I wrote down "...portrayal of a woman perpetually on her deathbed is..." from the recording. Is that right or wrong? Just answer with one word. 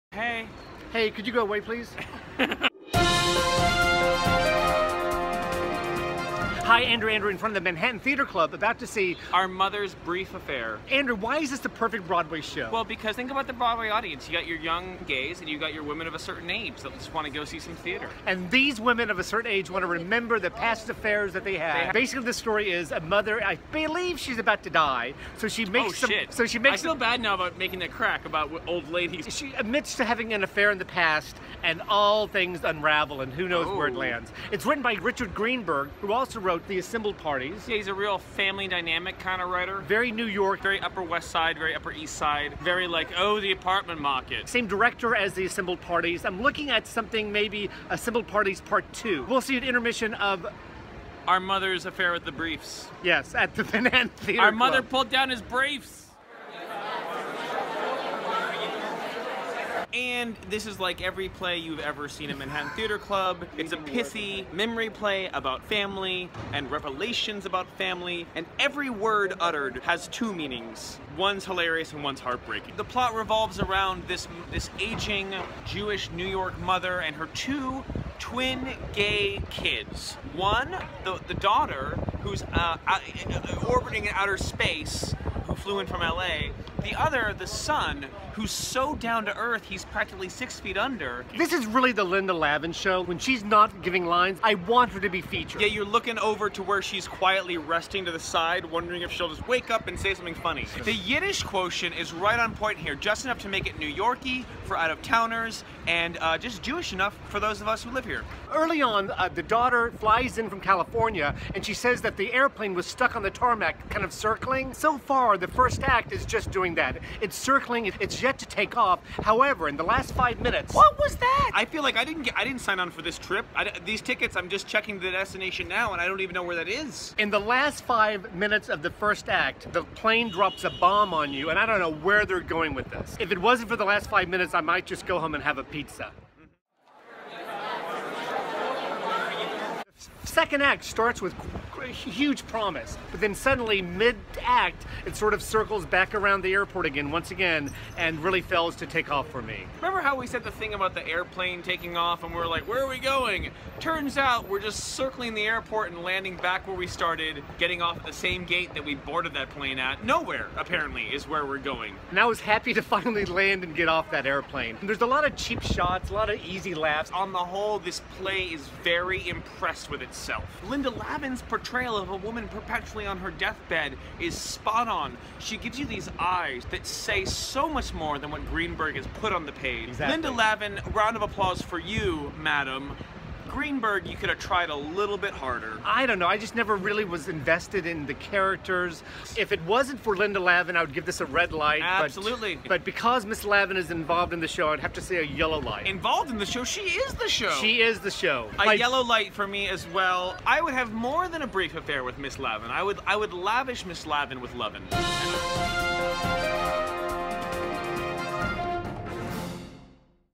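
right.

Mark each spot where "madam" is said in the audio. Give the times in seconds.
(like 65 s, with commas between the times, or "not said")
182 s.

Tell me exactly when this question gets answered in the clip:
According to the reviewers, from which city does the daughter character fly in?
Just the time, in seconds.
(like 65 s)
86 s.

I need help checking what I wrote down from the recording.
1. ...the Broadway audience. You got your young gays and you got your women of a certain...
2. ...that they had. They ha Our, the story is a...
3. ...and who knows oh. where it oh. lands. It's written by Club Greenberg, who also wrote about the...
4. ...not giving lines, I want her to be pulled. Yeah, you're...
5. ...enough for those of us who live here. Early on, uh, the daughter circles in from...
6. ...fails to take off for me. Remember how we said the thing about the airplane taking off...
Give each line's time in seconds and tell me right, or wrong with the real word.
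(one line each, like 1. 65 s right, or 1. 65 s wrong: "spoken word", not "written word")
1. 13 s right
2. 21 s wrong: "Basically", not "Our"
3. 33 s wrong: "Richard", not "Club"
4. 93 s wrong: "featured", not "pulled"
5. 106 s wrong: "flies", not "circles"
6. 148 s right.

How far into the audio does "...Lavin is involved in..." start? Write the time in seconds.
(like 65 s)
193 s.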